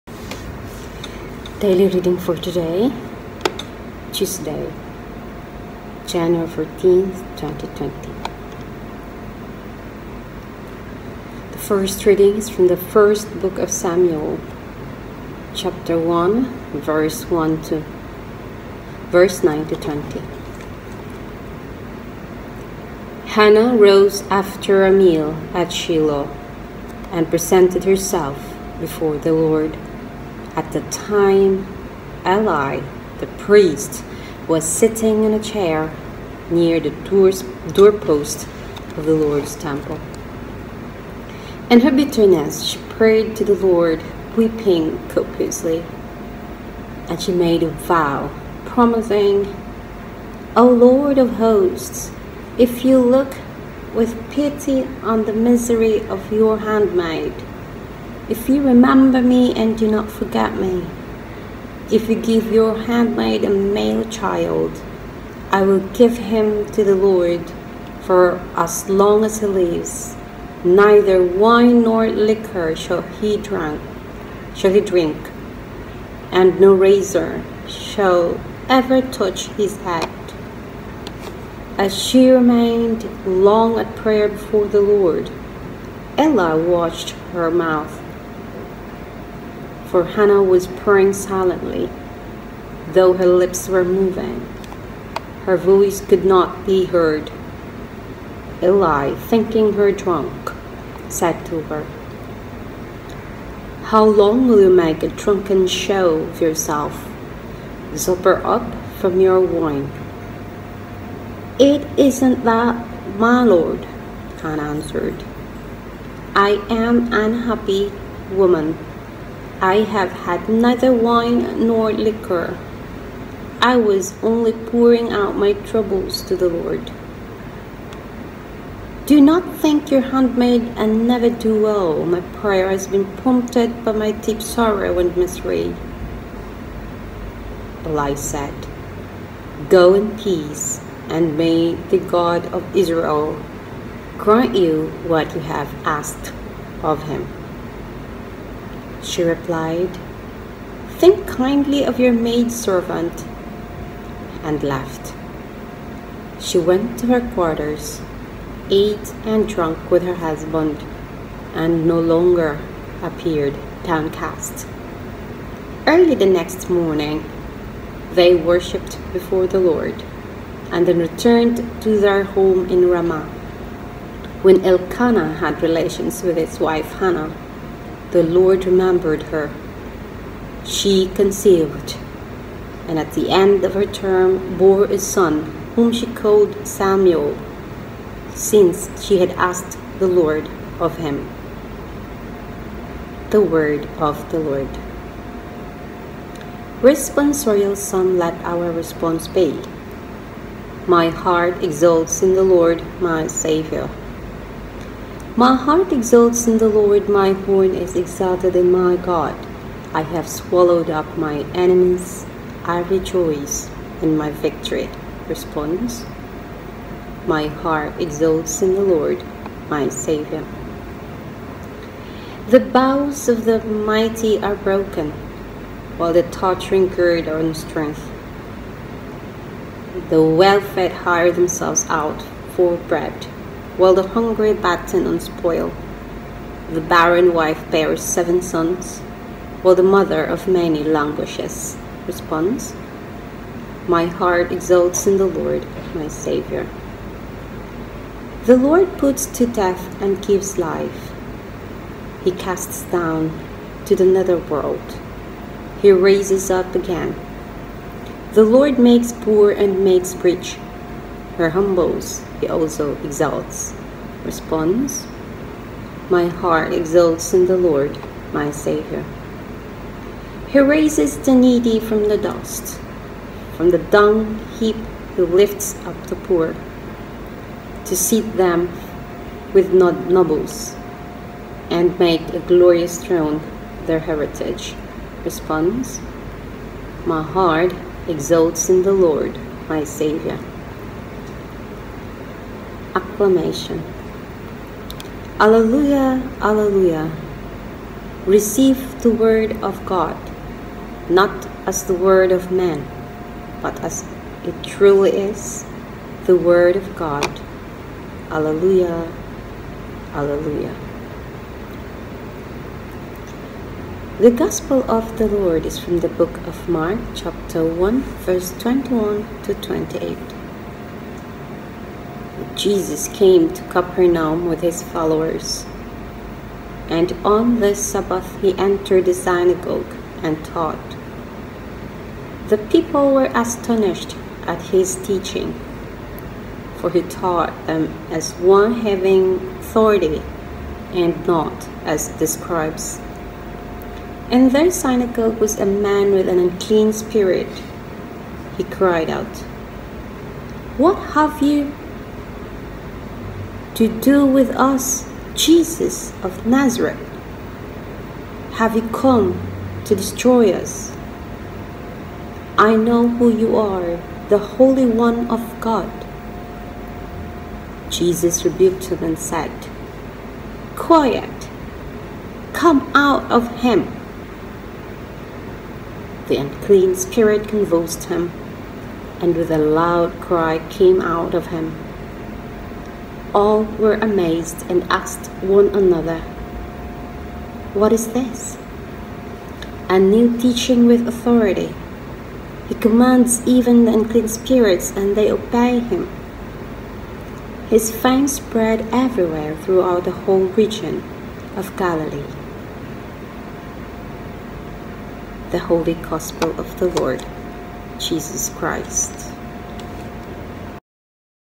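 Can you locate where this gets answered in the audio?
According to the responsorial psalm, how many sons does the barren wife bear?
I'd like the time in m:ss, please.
3:58.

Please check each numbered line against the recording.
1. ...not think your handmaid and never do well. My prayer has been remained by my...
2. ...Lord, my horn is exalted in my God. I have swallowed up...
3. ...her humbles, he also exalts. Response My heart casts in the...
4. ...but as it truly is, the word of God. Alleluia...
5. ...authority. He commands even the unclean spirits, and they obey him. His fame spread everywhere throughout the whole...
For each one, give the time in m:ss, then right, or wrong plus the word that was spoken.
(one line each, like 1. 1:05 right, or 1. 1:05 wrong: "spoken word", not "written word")
1. 2:09 wrong: "prompted", not "remained"
2. 3:26 right
3. 4:21 wrong: "exults", not "casts"
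4. 5:03 right
5. 6:31 right.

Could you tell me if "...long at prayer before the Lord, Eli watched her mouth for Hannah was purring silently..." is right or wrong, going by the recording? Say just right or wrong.
right.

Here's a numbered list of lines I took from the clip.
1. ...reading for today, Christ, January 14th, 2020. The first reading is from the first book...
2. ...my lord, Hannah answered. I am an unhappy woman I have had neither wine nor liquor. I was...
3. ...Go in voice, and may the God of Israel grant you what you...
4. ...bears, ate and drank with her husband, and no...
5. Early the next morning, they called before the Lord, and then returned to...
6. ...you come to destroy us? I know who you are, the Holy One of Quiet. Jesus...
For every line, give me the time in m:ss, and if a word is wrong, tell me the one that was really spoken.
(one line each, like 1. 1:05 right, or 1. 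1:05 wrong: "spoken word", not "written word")
1. 0:01 wrong: "Tuesday", not "Christ"
2. 1:53 right
3. 2:19 wrong: "peace", not "voice"
4. 2:37 wrong: "quarters", not "bears"
5. 2:45 wrong: "worshipped", not "called"
6. 5:58 wrong: "God", not "Quiet".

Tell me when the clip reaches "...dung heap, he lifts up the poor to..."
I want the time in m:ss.
4:33.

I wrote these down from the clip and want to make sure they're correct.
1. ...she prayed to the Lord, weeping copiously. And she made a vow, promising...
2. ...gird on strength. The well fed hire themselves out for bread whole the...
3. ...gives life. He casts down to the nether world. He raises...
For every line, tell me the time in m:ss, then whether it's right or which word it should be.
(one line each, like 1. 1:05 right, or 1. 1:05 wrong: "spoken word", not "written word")
1. 0:42 right
2. 3:46 wrong: "while", not "whole"
3. 4:10 right.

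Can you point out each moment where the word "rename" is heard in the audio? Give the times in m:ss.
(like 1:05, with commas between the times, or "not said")
not said.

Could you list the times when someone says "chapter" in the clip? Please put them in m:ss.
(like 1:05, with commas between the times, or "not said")
0:15, 5:17.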